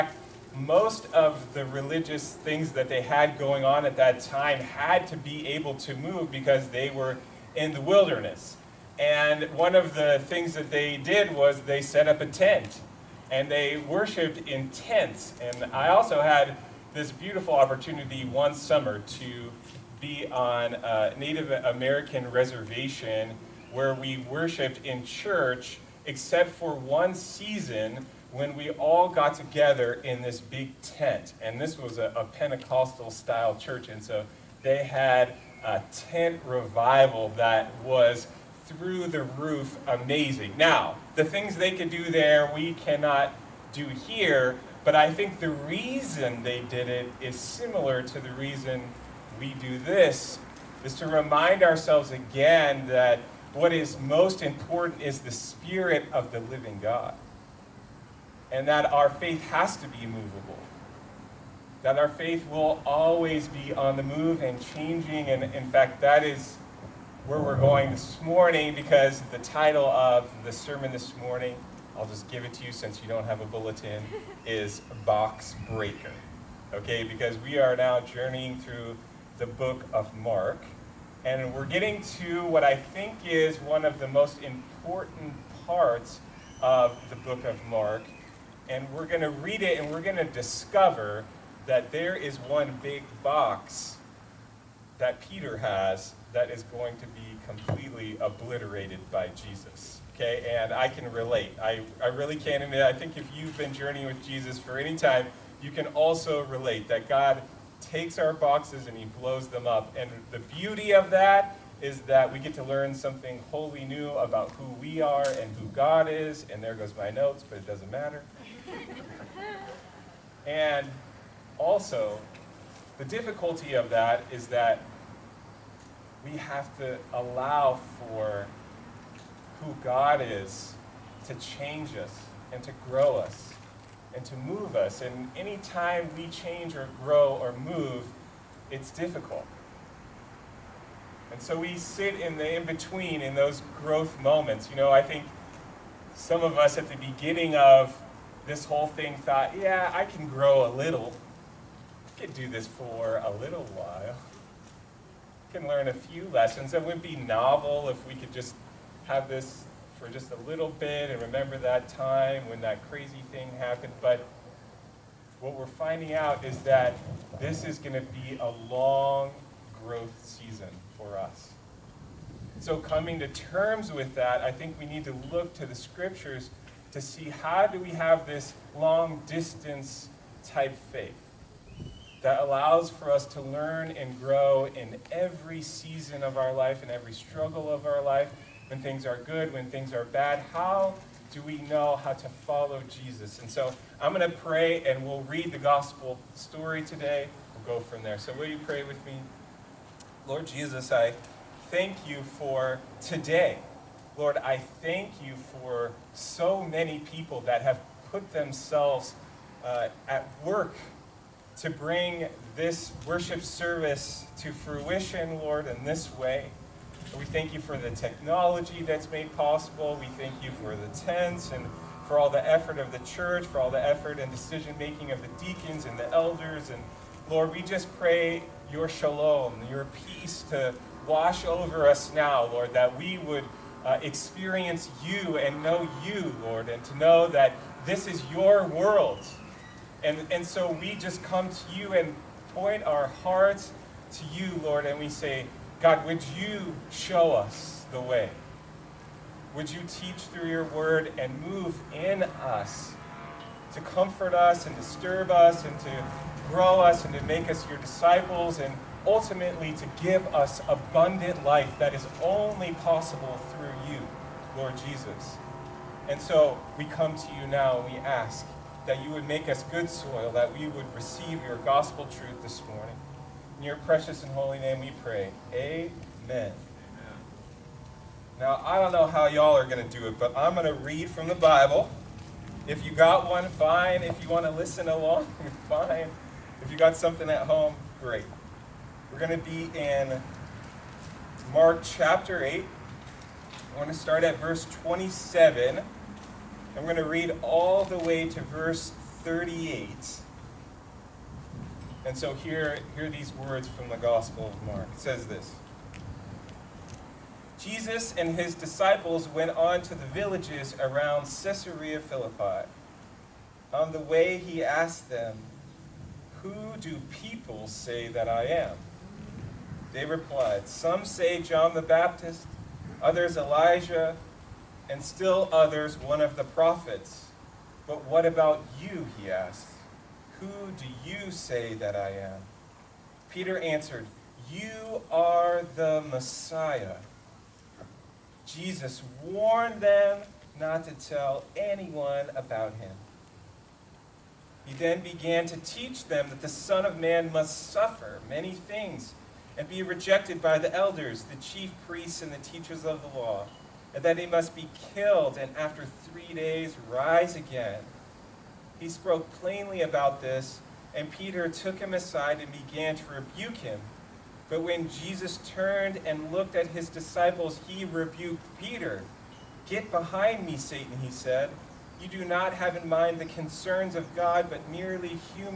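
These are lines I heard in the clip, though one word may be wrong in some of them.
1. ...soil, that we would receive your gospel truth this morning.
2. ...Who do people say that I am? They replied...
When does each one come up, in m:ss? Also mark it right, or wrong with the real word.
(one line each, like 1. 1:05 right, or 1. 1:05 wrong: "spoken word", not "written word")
1. 4:29 right
2. 5:16 right.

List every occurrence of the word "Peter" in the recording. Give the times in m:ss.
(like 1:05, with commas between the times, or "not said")
1:35, 5:33, 6:01, 6:08.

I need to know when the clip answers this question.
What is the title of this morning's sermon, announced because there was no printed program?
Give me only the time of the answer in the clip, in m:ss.
1:15.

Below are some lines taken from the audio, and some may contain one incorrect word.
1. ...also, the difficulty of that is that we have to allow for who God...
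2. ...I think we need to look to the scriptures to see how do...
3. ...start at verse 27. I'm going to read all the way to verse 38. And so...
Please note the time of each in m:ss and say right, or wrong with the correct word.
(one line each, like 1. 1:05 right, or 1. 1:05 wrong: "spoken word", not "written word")
1. 2:01 right
2. 2:54 right
3. 4:53 right.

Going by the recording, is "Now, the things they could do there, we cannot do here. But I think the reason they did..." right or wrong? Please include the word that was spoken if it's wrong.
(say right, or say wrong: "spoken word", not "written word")
right.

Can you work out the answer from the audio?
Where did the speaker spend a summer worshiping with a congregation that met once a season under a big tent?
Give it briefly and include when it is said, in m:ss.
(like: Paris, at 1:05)
Native American reservation, at 0:21.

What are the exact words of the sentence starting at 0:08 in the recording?
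And one of the things that they did was they set up a tent and they worshiped in tents.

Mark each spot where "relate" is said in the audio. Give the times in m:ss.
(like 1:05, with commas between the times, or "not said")
1:41, 1:46.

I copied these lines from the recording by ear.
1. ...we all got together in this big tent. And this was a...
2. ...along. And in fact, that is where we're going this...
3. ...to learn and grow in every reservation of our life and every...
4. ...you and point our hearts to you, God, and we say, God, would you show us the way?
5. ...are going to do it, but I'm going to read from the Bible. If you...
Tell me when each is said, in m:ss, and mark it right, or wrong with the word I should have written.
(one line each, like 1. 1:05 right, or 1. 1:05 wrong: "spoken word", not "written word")
1. 0:28 right
2. 1:04 wrong: "changing", not "along"
3. 3:03 wrong: "season", not "reservation"
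4. 4:01 wrong: "Lord", not "God"
5. 4:39 right.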